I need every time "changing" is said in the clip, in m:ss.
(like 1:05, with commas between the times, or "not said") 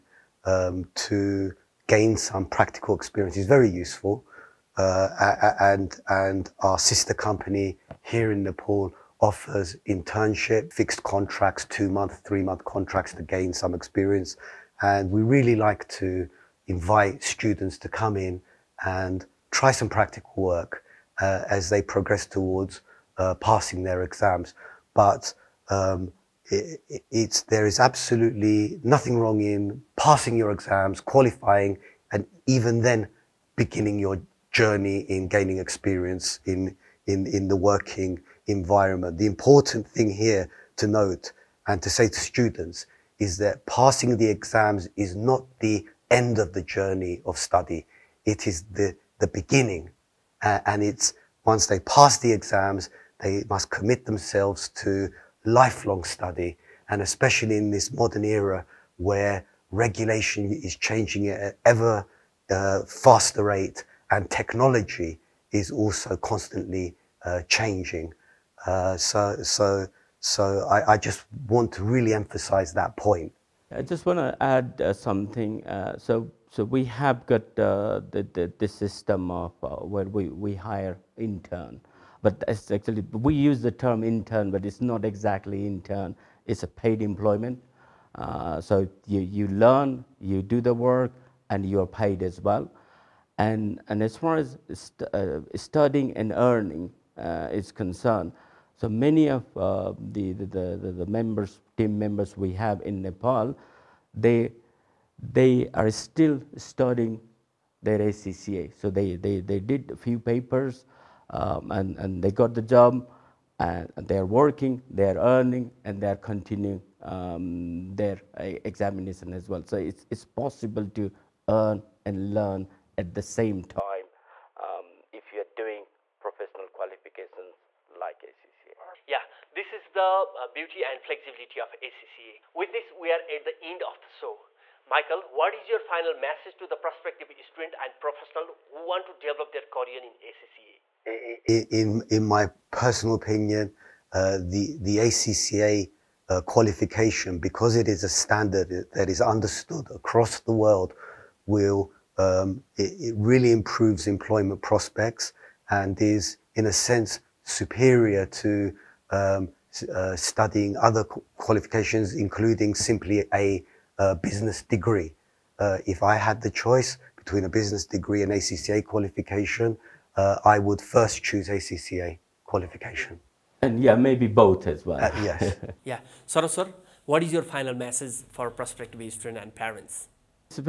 1:00, 1:07.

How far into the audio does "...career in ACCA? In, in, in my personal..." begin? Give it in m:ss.
2:19.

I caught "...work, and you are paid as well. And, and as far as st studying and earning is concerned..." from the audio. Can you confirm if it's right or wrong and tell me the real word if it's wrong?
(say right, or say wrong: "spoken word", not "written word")
right.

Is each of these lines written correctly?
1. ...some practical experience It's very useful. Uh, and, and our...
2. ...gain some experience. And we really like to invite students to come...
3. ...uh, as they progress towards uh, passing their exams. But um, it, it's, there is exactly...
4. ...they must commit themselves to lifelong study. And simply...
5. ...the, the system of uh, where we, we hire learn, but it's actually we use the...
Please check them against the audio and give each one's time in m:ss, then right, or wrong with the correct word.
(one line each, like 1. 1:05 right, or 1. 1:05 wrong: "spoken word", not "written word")
1. 0:02 right
2. 0:13 right
3. 0:21 wrong: "absolutely", not "exactly"
4. 0:53 wrong: "especially", not "simply"
5. 1:18 wrong: "intern", not "learn".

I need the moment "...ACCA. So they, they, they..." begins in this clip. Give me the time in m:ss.
1:47.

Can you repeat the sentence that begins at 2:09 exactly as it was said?
Yeah, this is the uh, beauty and flexibility of ACCA.